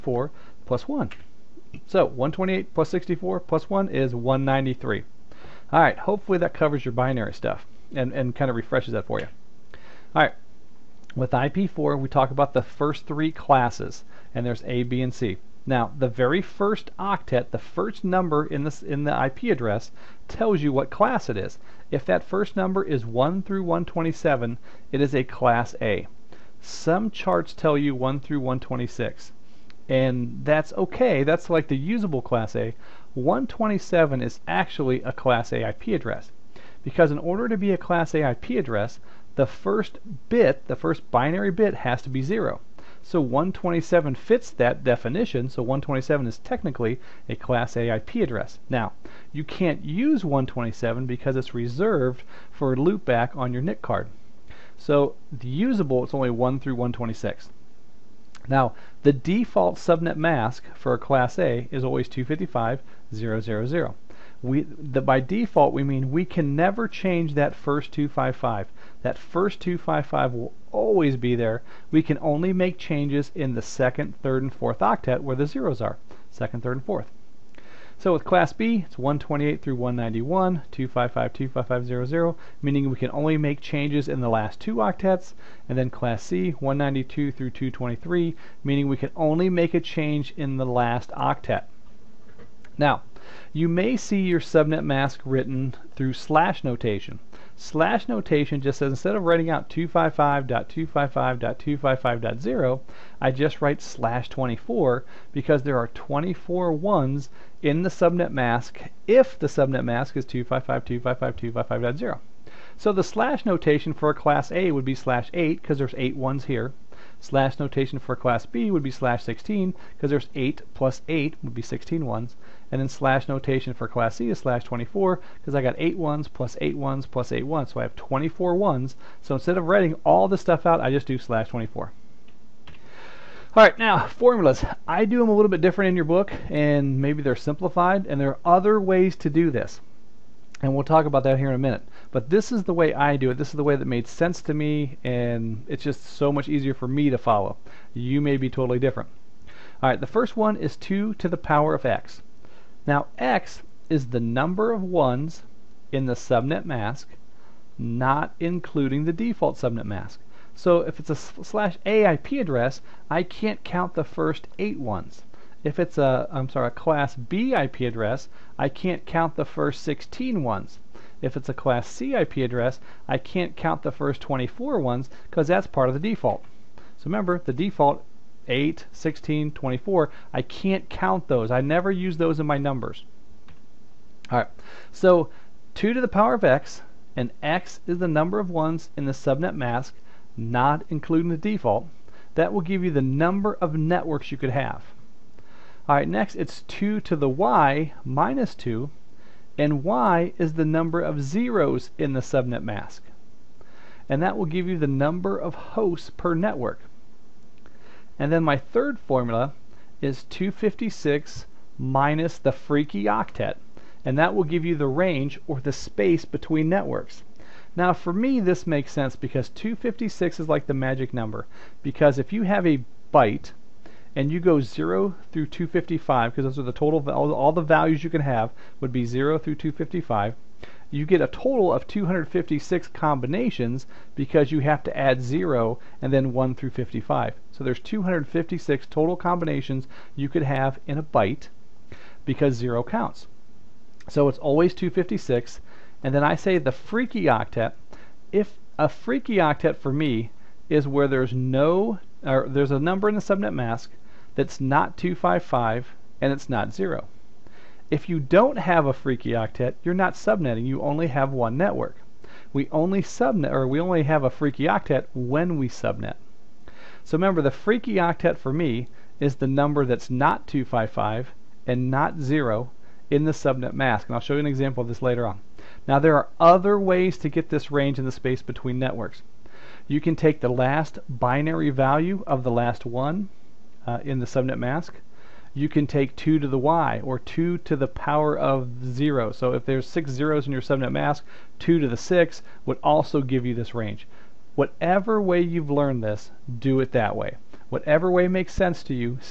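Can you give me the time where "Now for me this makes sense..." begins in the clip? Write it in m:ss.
3:37.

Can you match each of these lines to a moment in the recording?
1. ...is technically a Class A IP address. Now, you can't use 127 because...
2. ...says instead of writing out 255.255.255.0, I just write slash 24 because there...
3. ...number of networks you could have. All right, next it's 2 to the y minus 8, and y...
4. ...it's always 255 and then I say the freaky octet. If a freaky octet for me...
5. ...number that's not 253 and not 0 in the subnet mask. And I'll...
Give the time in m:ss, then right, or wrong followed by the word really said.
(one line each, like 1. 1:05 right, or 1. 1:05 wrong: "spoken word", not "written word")
1. 0:46 right
2. 1:38 right
3. 3:13 wrong: "2", not "8"
4. 4:04 wrong: "256", not "255"
5. 4:29 wrong: "255", not "253".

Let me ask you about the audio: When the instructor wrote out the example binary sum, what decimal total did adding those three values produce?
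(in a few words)
193.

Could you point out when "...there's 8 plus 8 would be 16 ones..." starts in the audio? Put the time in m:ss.
2:00.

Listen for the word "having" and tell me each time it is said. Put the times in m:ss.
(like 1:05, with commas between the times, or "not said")
not said.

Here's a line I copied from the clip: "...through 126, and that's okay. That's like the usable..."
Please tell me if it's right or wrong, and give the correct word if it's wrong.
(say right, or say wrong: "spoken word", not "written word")
right.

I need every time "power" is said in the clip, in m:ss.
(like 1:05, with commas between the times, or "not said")
2:31, 3:06, 4:47.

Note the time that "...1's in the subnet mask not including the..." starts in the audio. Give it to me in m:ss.
2:34.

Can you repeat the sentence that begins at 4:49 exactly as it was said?
So if there's 6 zeros in your subnet mask, 2 to the 6 would also give you this range.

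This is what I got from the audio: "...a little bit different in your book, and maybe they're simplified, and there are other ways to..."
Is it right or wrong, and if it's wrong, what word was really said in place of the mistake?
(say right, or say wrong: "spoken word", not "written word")
right.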